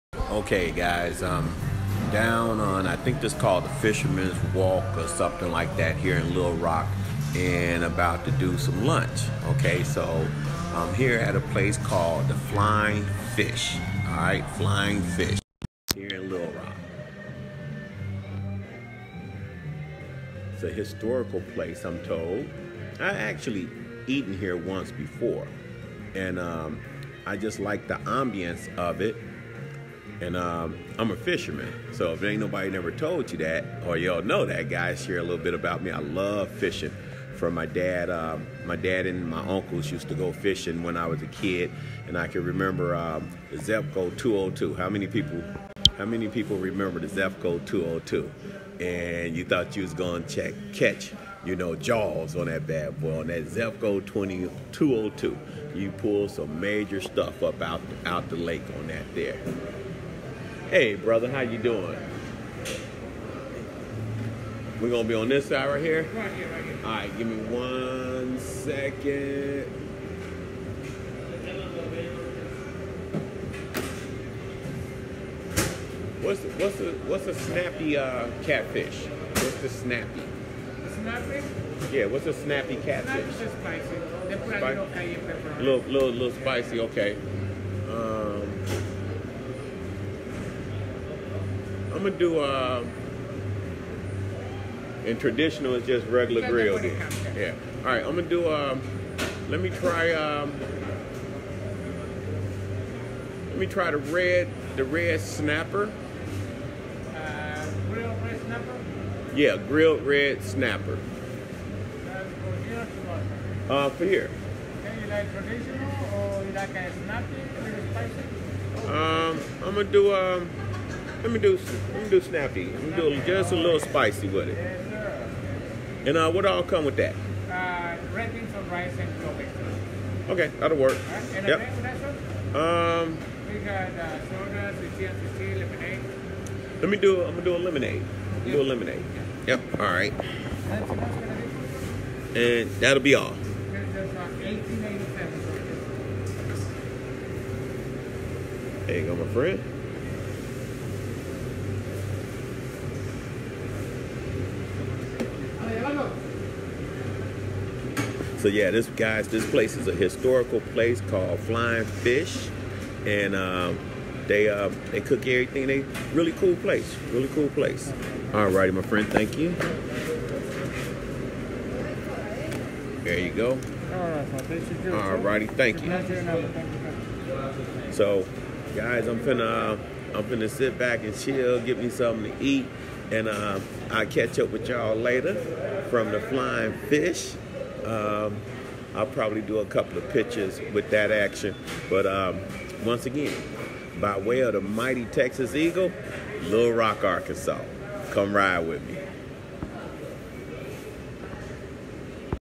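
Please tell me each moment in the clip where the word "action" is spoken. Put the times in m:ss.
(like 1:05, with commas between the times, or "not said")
3:11.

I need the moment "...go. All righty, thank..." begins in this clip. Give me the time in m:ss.
2:53.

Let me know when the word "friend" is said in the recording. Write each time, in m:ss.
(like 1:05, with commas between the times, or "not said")
2:29, 2:48.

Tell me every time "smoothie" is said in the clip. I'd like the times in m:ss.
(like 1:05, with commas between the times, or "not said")
not said.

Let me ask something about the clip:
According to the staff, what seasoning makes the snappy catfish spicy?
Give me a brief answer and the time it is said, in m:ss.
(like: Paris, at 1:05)
Cayenne pepper, at 1:24.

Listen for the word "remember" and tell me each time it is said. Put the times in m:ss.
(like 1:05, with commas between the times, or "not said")
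0:42, 0:46.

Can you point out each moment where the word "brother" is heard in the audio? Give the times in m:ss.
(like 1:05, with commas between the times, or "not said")
1:00.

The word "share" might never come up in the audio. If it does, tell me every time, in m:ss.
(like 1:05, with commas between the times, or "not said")
0:35.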